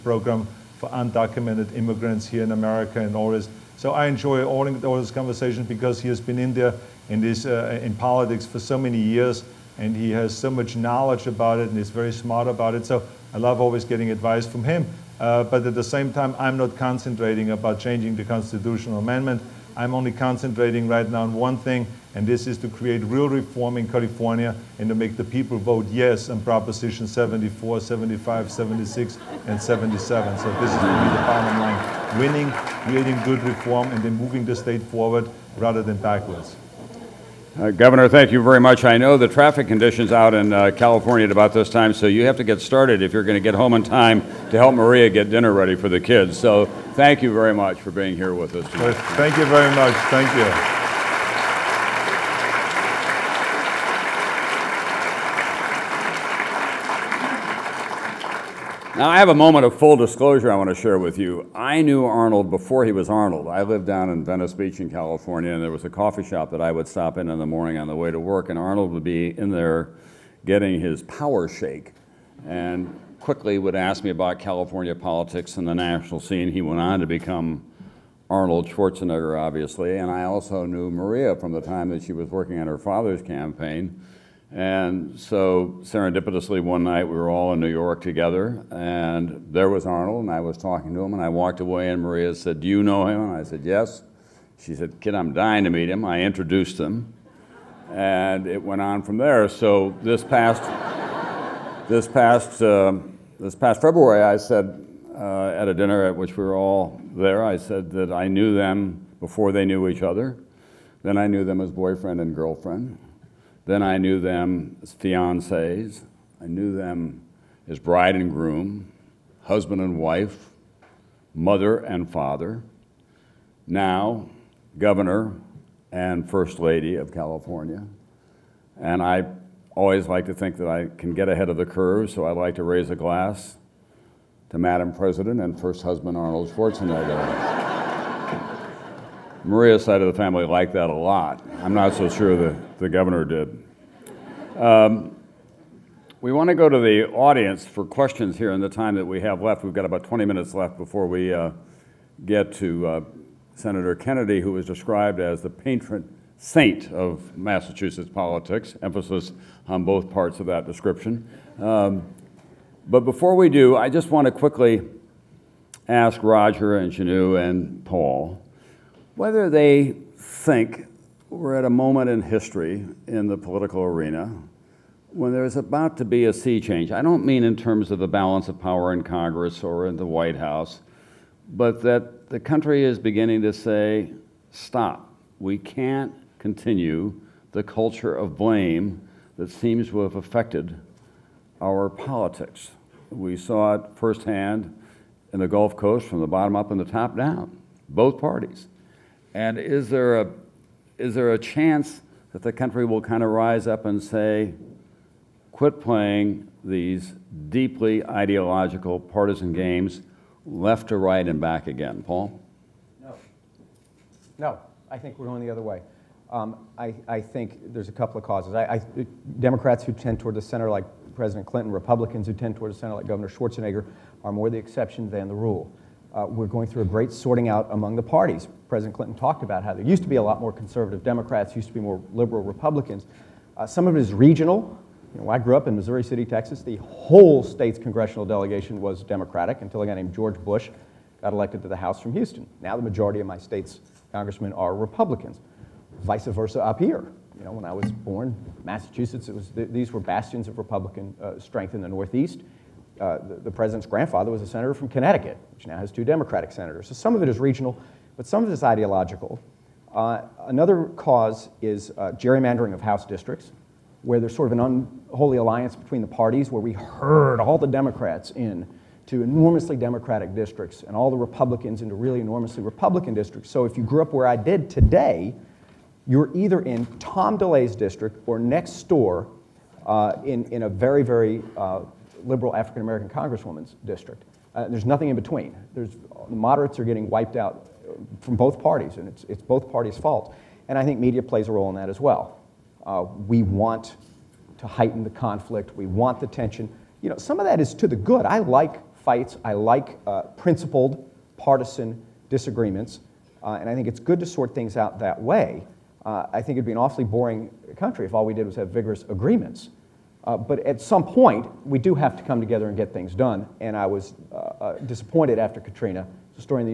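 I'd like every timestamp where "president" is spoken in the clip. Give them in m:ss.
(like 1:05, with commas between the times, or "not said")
2:14, 3:41, 3:48, 4:13.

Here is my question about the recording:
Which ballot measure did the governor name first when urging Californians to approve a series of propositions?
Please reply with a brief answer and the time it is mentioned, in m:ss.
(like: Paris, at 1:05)
Proposition 74, at 0:26.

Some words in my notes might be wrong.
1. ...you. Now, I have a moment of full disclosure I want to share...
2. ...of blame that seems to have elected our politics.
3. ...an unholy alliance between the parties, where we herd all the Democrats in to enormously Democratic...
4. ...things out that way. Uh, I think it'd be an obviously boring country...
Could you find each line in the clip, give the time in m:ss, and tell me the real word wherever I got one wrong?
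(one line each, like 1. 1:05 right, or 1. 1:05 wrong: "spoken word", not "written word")
1. 0:50 right
2. 3:08 wrong: "affected", not "elected"
3. 4:24 right
4. 5:04 wrong: "awfully", not "obviously".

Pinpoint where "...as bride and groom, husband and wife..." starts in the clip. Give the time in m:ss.
1:57.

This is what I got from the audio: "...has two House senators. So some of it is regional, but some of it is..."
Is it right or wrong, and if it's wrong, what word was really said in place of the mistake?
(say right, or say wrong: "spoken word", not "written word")
wrong: "Democratic", not "House".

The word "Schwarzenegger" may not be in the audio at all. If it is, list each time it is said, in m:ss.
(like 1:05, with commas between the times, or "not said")
1:18, 2:16, 3:43.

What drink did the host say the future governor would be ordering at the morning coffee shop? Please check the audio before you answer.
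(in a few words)
power shake.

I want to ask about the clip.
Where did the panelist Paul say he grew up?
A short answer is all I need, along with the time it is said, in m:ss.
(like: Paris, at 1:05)
Missouri City, Texas, at 3:55.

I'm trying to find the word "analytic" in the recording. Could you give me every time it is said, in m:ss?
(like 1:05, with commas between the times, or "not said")
not said.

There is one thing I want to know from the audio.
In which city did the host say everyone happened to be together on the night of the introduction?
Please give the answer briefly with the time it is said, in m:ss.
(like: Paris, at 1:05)
New York, at 1:27.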